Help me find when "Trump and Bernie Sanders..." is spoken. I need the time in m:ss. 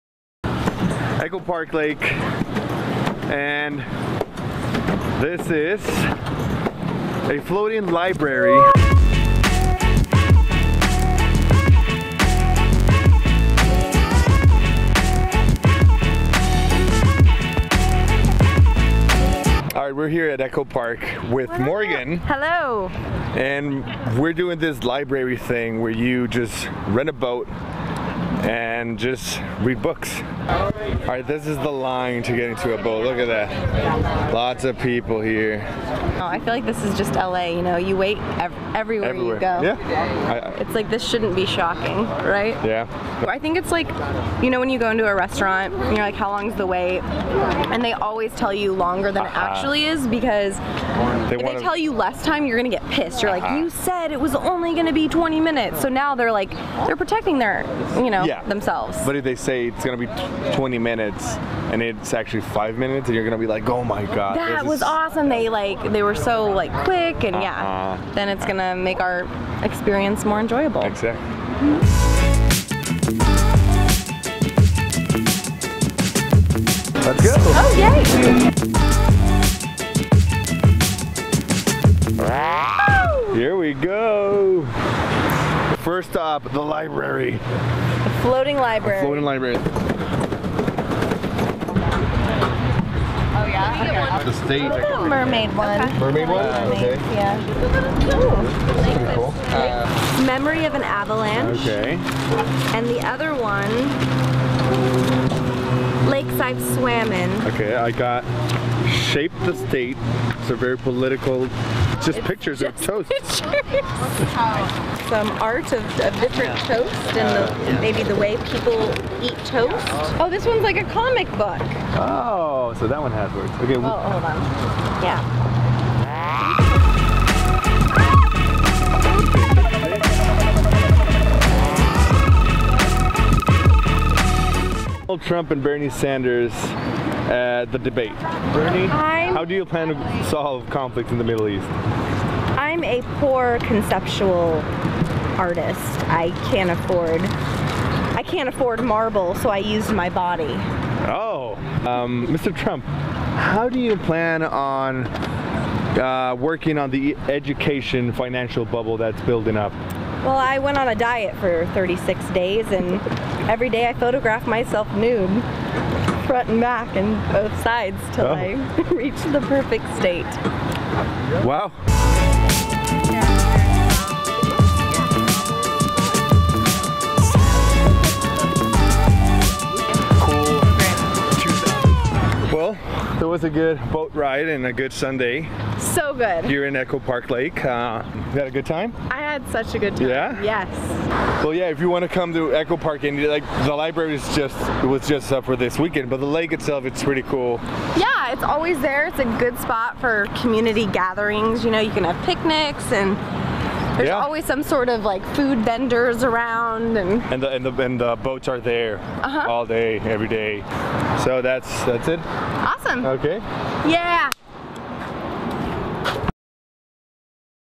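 2:15.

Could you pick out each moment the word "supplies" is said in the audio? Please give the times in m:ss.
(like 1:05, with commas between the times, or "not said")
not said.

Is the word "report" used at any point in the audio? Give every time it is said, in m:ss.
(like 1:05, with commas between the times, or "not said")
not said.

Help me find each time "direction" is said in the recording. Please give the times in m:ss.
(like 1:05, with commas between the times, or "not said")
not said.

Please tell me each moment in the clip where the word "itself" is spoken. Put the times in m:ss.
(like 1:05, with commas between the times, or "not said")
3:16.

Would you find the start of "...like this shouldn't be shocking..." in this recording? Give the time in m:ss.
0:40.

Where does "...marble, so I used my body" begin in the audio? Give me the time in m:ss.
2:28.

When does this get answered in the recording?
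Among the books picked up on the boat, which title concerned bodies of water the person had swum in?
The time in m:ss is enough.
1:46.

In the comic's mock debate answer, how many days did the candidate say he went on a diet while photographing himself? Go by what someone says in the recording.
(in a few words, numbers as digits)
36.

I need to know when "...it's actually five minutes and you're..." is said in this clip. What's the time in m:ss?
1:01.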